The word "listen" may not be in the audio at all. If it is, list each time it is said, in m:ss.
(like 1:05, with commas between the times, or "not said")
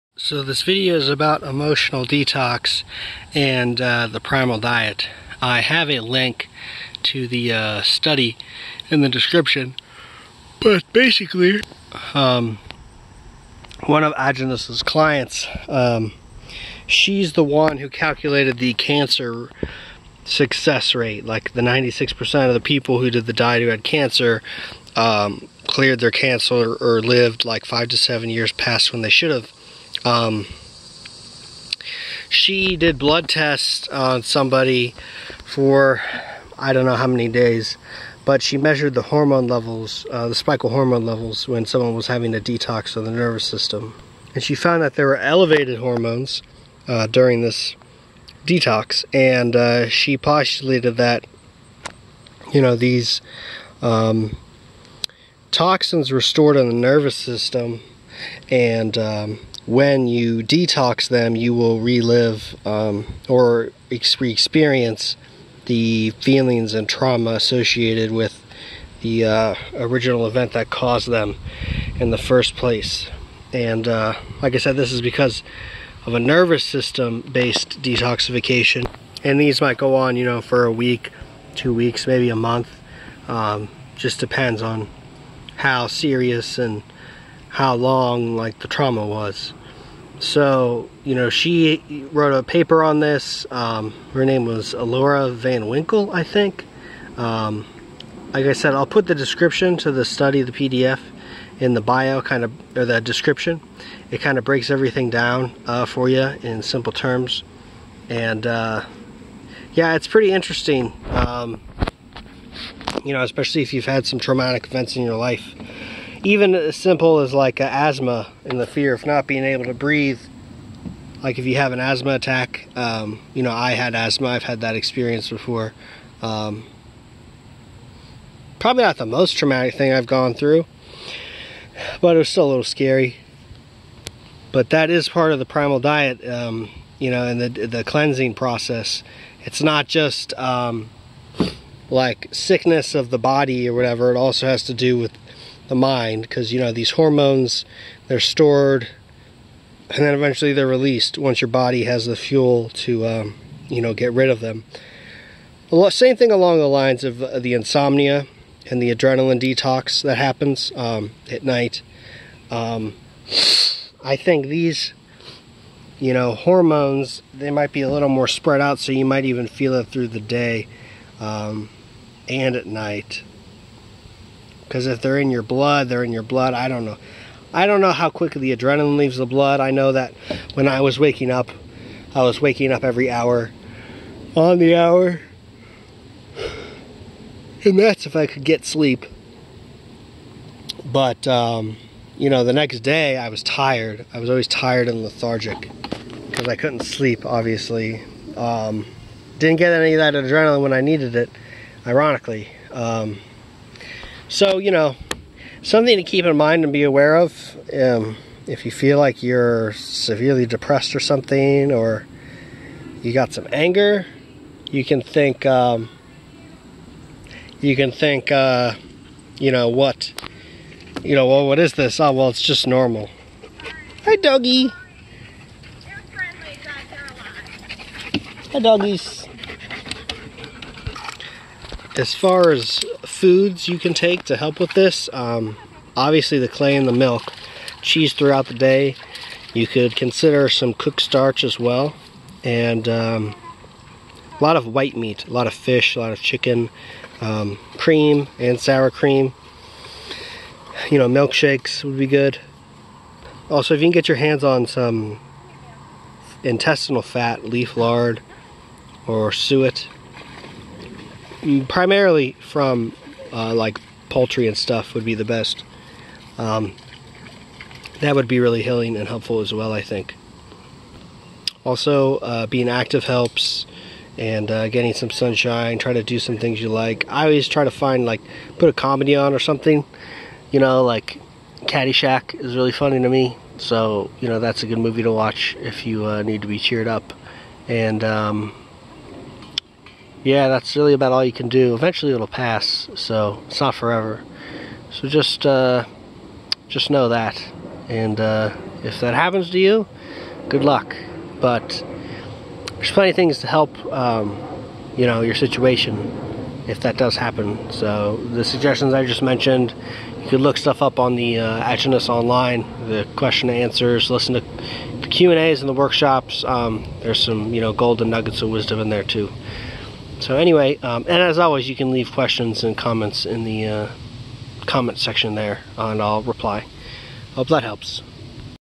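5:14.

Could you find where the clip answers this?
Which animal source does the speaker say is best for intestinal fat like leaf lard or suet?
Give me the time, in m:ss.
4:24.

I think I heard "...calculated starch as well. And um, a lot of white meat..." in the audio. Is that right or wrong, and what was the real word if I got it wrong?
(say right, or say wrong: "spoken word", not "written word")
wrong: "cooked", not "calculated".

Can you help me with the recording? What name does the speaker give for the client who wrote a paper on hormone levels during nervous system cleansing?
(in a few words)
Alora Van Winkle.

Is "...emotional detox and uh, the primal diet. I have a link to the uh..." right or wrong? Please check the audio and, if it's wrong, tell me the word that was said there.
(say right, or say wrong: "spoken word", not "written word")
right.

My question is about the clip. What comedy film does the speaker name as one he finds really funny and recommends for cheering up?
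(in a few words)
Caddyshack.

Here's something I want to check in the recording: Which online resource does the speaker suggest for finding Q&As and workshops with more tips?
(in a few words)
Aajonus online.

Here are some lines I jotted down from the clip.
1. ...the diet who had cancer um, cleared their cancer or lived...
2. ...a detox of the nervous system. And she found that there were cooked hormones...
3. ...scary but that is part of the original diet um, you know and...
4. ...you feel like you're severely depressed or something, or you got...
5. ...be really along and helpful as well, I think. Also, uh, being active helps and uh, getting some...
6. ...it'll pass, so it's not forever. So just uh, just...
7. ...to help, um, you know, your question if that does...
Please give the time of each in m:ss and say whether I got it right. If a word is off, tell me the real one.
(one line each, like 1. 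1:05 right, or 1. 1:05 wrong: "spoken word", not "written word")
1. 0:23 right
2. 0:42 wrong: "elevated", not "cooked"
3. 2:12 wrong: "primal", not "original"
4. 3:28 right
5. 4:28 wrong: "healing", not "along"
6. 4:52 right
7. 5:03 wrong: "situation", not "question".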